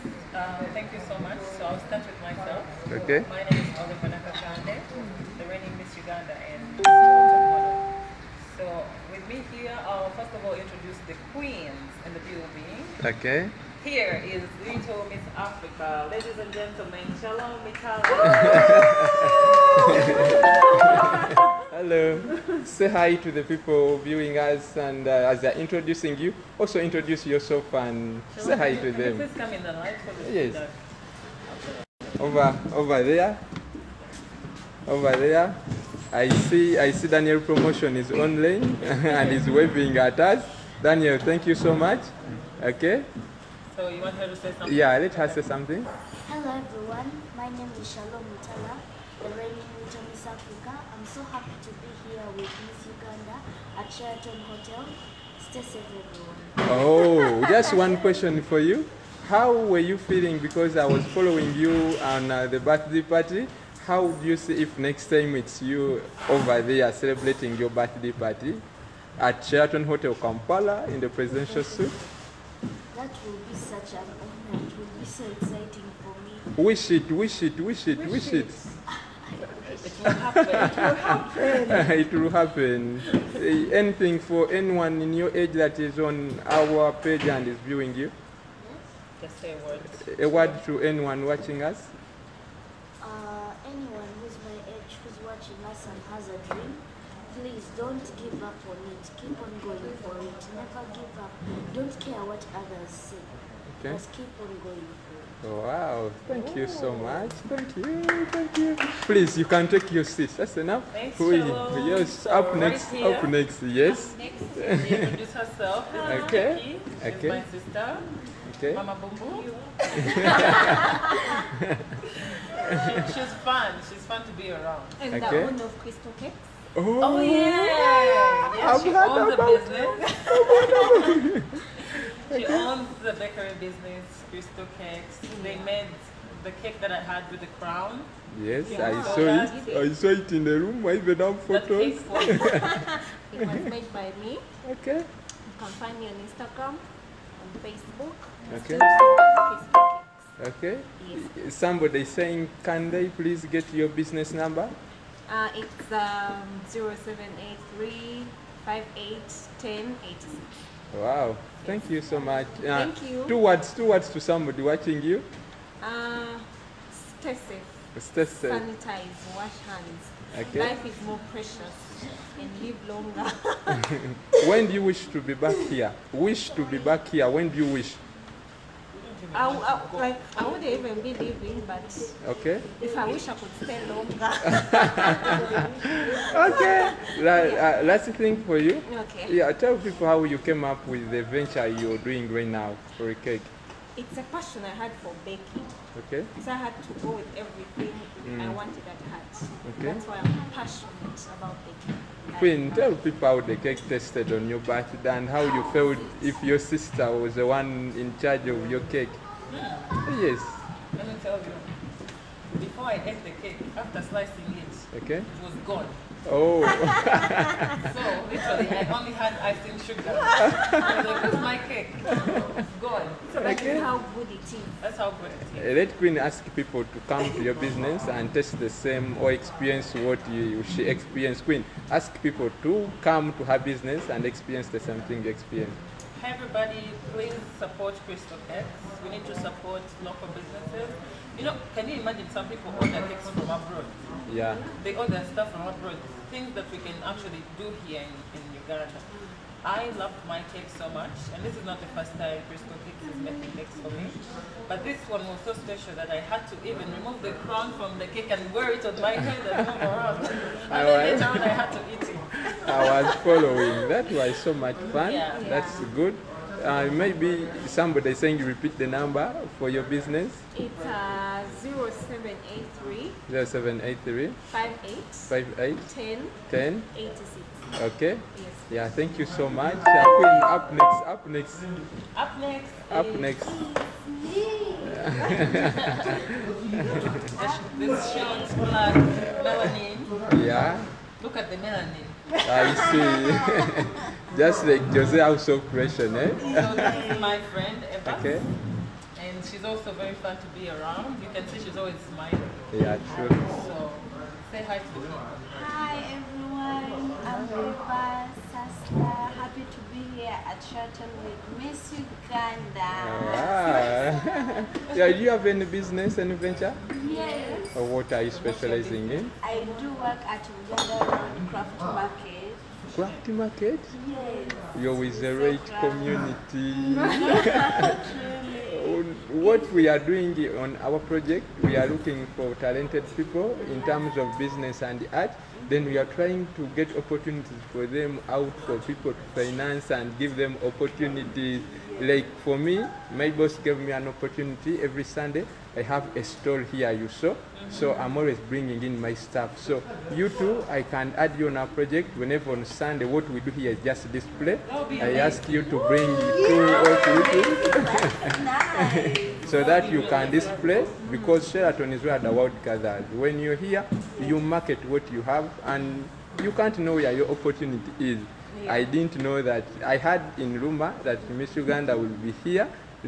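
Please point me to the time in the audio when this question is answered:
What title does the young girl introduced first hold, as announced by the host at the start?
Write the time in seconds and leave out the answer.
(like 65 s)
14 s.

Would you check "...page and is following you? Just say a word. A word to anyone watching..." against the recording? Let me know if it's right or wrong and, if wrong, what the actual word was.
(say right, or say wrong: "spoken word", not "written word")
wrong: "viewing", not "following".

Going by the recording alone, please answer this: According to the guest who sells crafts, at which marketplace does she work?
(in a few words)
Uganda Craft market.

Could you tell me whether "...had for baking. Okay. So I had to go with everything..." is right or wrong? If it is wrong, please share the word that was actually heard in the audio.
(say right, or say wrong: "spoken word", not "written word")
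right.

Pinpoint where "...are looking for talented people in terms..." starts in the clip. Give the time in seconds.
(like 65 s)
331 s.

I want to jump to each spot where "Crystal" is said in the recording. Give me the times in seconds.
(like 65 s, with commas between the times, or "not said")
125 s, 134 s, 238 s, 252 s.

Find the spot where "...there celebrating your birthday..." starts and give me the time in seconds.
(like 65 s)
66 s.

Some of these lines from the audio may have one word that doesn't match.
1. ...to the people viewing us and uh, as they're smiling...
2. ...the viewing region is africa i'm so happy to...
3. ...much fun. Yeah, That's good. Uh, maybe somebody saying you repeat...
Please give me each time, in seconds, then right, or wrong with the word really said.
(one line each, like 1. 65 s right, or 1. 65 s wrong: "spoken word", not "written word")
1. 23 s wrong: "introducing", not "smiling"
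2. 49 s wrong: "reigning", not "viewing"
3. 264 s right.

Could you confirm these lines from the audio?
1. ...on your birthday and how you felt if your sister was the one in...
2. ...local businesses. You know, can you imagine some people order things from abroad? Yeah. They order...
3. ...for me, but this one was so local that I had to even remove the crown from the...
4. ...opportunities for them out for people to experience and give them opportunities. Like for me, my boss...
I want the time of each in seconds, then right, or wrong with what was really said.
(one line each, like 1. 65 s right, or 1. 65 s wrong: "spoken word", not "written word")
1. 204 s right
2. 240 s right
3. 253 s wrong: "special", not "local"
4. 336 s wrong: "finance", not "experience".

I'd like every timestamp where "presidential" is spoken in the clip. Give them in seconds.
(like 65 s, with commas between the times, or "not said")
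71 s.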